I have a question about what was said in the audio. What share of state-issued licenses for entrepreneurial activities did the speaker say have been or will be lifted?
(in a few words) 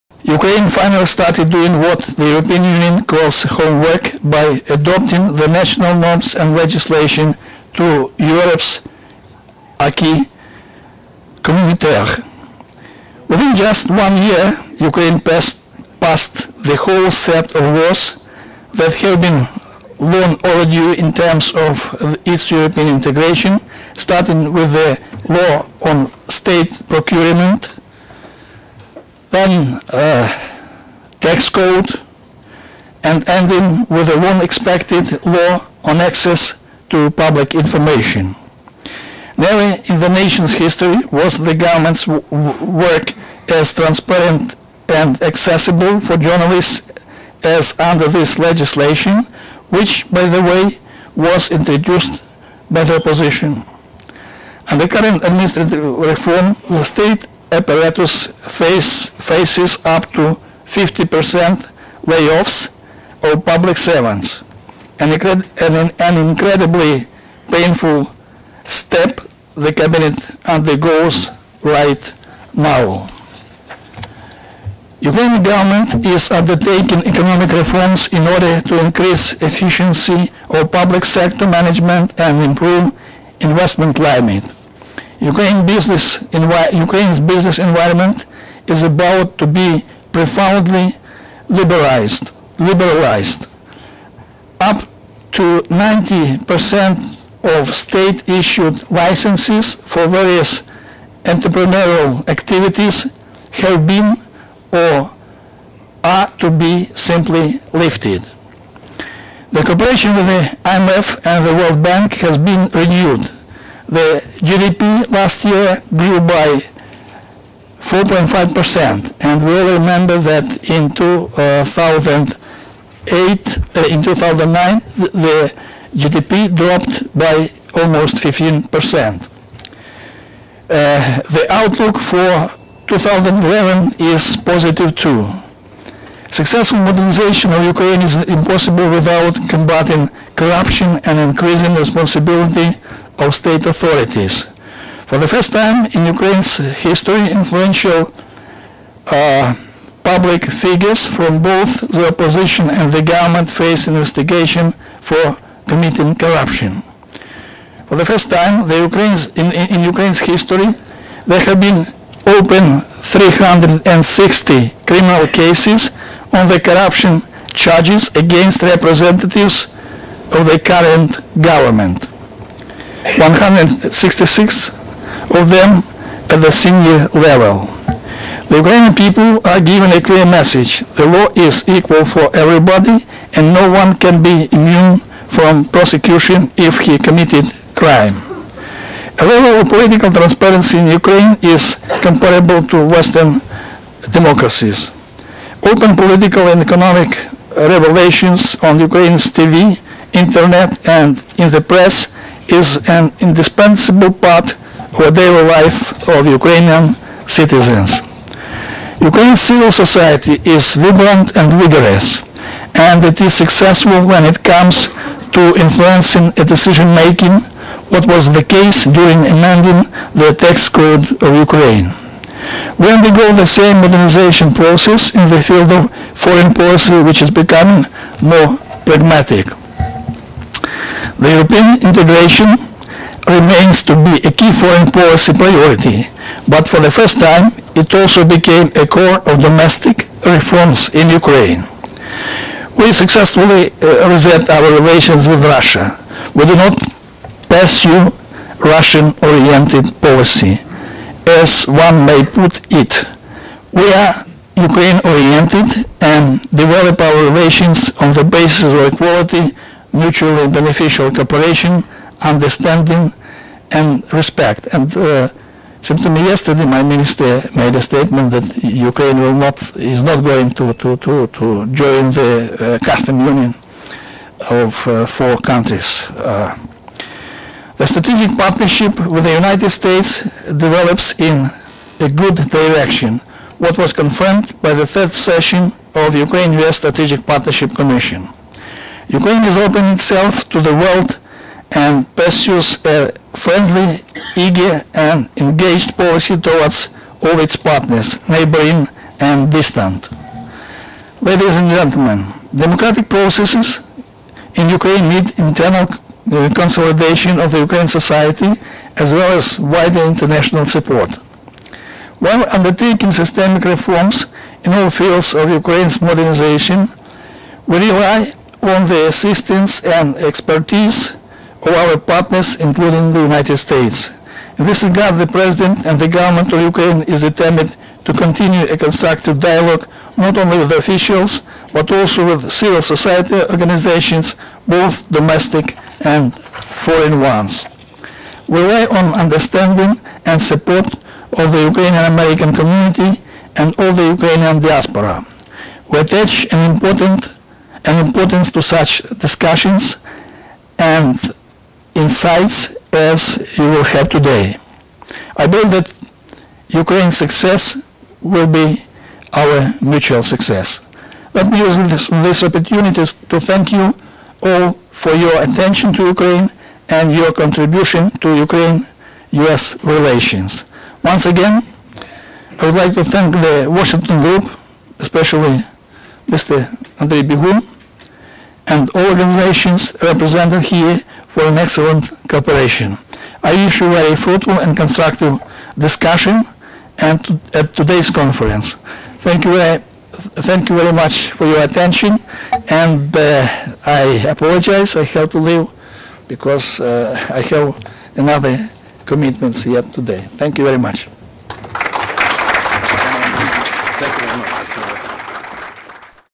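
Up to 90%.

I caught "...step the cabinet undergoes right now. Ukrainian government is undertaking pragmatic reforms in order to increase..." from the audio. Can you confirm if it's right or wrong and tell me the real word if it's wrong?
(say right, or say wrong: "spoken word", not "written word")
wrong: "economic", not "pragmatic".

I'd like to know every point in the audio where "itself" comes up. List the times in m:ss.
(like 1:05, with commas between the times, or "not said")
4:49.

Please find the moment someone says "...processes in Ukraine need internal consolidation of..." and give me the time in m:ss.
5:03.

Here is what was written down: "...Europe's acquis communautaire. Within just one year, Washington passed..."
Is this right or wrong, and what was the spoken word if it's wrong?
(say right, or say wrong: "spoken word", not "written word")
wrong: "Ukraine", not "Washington".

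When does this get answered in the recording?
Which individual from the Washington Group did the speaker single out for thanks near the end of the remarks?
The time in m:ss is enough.
6:16.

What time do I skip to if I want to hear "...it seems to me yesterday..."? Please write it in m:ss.
4:25.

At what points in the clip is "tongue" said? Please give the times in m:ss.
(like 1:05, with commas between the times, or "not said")
not said.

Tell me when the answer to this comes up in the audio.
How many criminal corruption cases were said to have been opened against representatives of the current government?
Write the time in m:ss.
2:43.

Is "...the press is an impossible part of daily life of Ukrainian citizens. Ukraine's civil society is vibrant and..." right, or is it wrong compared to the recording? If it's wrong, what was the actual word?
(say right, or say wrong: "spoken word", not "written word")
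wrong: "indispensable", not "impossible".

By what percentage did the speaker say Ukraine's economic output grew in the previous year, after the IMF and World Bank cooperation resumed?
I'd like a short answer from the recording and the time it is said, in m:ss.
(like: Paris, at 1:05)
4.5%, at 1:57.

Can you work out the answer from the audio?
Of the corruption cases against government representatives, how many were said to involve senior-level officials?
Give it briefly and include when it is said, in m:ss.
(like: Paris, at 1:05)
166, at 2:53.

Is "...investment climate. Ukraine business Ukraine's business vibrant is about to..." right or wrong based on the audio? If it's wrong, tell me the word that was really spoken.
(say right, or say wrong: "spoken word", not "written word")
wrong: "environment", not "vibrant".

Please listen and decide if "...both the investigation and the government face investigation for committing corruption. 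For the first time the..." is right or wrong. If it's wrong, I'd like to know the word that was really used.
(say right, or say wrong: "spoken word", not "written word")
wrong: "opposition", not "investigation".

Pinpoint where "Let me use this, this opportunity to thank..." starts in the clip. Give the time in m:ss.
6:01.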